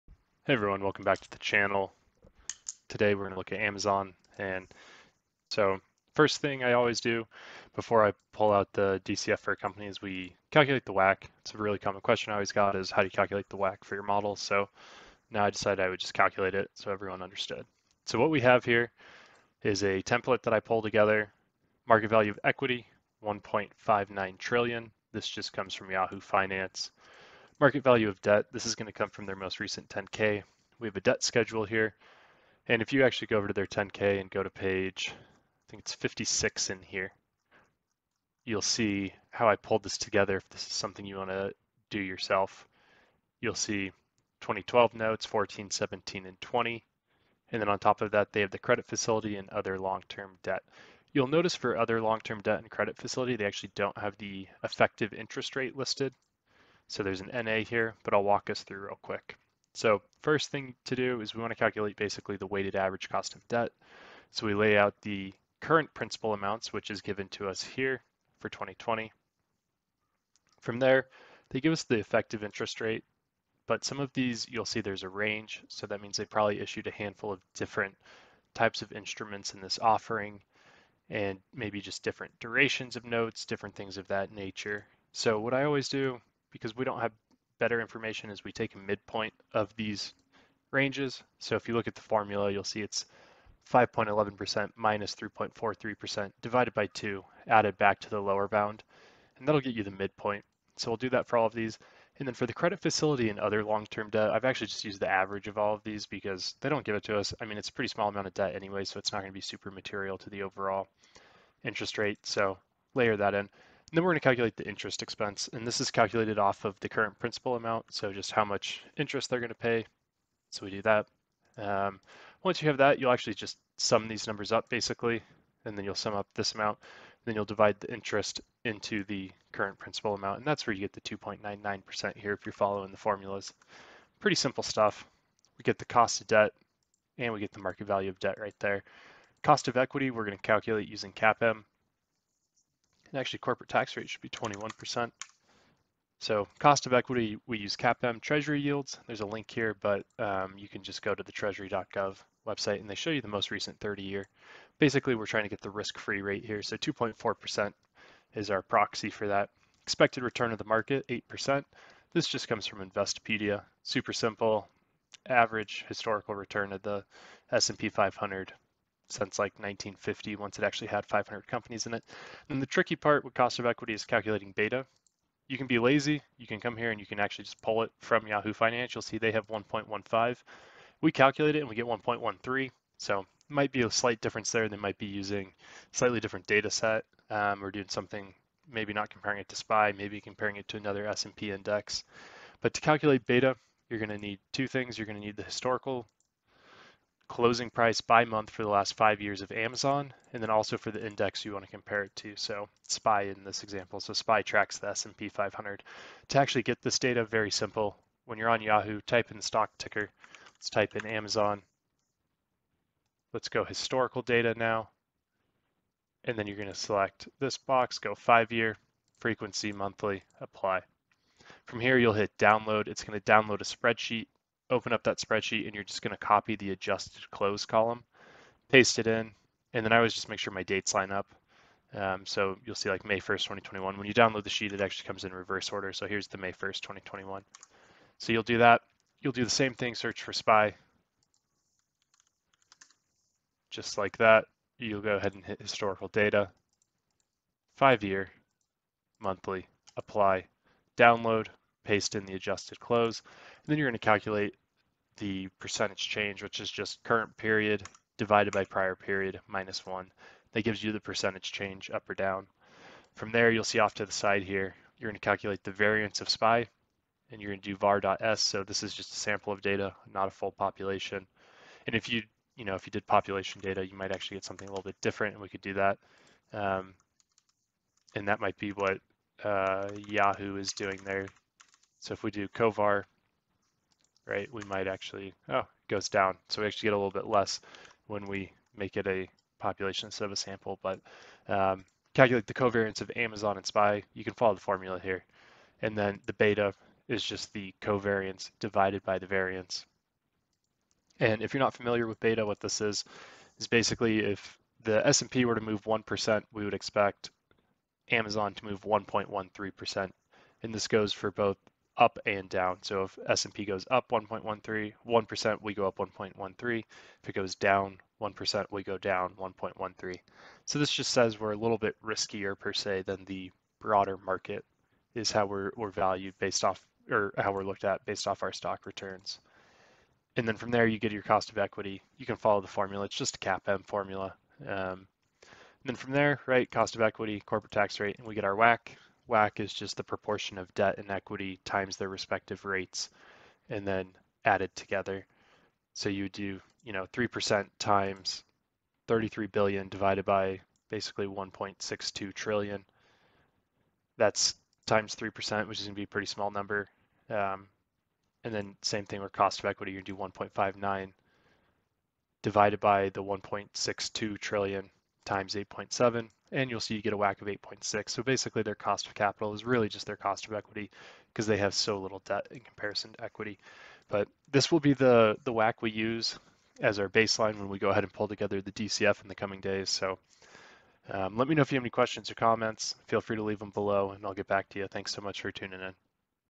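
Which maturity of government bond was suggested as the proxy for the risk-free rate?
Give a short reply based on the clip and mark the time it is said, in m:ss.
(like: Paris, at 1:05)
30 year, at 2:33.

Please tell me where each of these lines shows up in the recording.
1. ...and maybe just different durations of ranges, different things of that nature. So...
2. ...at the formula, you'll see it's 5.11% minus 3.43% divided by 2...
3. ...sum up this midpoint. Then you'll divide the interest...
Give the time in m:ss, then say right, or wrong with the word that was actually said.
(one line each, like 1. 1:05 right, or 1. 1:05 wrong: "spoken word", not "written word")
1. 1:21 wrong: "notes", not "ranges"
2. 1:31 right
3. 2:05 wrong: "amount", not "midpoint".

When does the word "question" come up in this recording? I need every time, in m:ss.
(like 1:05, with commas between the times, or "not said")
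0:12, 6:21.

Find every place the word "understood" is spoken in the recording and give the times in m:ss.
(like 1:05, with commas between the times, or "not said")
0:17.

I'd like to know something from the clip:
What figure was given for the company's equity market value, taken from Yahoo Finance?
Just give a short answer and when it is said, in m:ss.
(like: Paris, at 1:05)
1.59 trillion, at 0:23.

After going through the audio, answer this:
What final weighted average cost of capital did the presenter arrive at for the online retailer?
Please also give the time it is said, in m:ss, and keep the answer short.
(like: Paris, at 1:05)
8.6, at 6:07.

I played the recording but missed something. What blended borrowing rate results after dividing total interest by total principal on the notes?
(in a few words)
2.99%.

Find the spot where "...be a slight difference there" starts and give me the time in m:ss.
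3:03.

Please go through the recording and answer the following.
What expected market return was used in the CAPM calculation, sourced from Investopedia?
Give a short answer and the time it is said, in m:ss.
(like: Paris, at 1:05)
8%, at 2:41.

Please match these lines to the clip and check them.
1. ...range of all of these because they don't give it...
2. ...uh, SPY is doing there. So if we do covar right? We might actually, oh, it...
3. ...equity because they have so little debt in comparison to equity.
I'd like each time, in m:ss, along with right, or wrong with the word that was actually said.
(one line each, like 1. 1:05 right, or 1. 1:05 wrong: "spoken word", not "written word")
1. 1:45 wrong: "average", not "range"
2. 4:39 wrong: "Yahoo", not "SPY"
3. 6:10 right.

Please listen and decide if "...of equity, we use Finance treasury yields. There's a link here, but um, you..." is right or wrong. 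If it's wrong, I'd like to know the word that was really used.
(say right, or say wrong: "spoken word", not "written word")
wrong: "CAPM", not "Finance".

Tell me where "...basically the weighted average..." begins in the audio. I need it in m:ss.
1:01.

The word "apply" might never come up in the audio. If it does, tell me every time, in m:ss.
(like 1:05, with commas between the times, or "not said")
3:40, 4:09.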